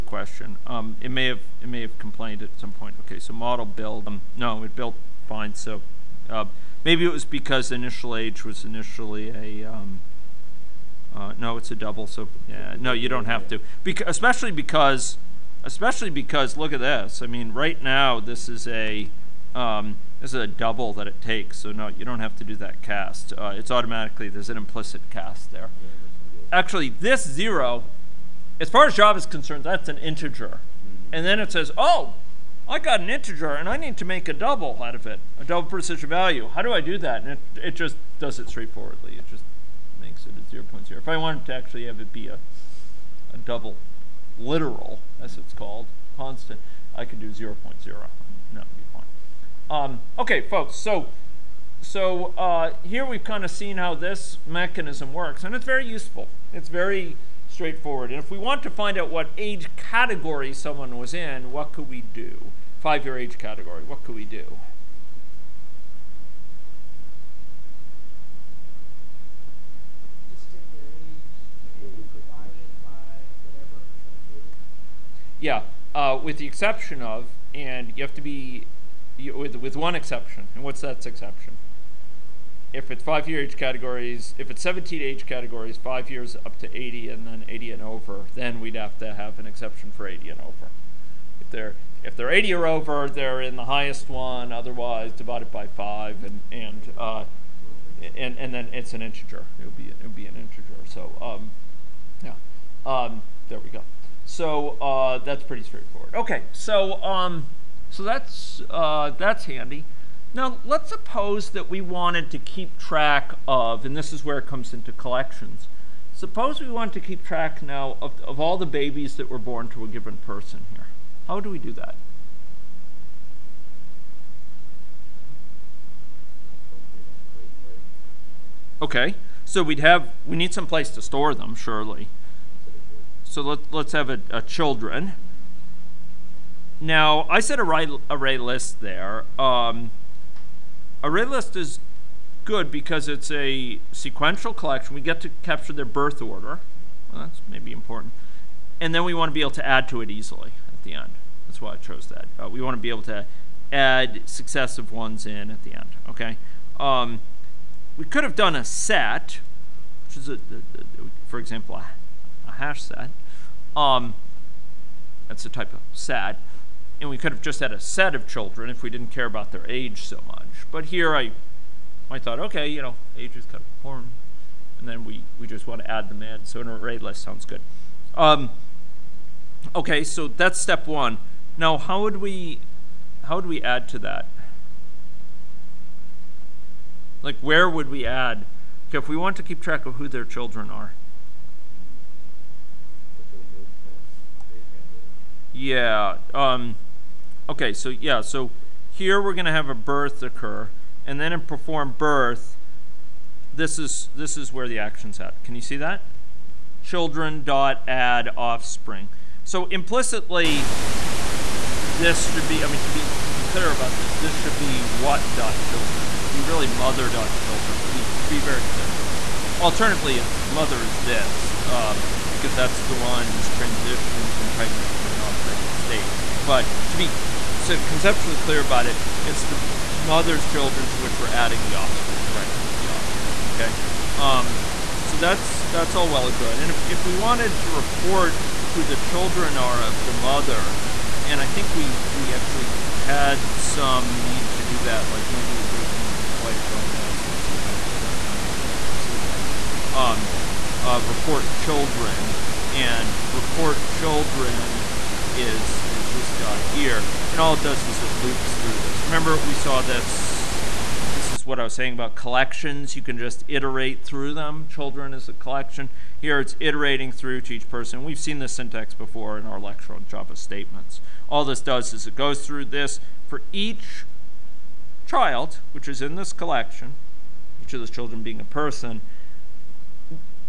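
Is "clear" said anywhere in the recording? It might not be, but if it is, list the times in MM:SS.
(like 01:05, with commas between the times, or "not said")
03:33, 03:38, 03:48.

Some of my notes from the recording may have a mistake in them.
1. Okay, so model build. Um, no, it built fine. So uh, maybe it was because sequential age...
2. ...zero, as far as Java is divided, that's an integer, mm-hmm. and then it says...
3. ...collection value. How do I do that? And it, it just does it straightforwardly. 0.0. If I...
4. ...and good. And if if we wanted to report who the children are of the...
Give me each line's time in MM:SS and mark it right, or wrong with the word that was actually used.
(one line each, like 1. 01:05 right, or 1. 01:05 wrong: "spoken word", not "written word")
1. 00:03 wrong: "initial", not "sequential"
2. 00:27 wrong: "concerned", not "divided"
3. 00:35 wrong: "precision", not "collection"
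4. 03:56 right.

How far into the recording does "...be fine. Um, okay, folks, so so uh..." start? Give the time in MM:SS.
00:48.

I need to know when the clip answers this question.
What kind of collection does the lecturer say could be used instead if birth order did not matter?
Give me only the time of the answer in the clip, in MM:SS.
02:42.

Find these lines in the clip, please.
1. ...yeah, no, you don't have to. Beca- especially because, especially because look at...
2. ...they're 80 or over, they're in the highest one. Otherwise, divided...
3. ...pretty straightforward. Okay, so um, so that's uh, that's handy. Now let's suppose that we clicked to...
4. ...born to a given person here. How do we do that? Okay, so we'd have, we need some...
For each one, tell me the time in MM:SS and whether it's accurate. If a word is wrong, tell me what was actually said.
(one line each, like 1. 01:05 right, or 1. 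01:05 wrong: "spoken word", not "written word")
1. 00:12 right
2. 01:32 right
3. 01:45 wrong: "wanted", not "clicked"
4. 01:59 right.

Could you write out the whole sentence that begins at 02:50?
But here I, I thought, okay, you know, age is kind of important.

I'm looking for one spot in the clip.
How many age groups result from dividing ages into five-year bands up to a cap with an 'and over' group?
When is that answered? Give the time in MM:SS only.
01:24.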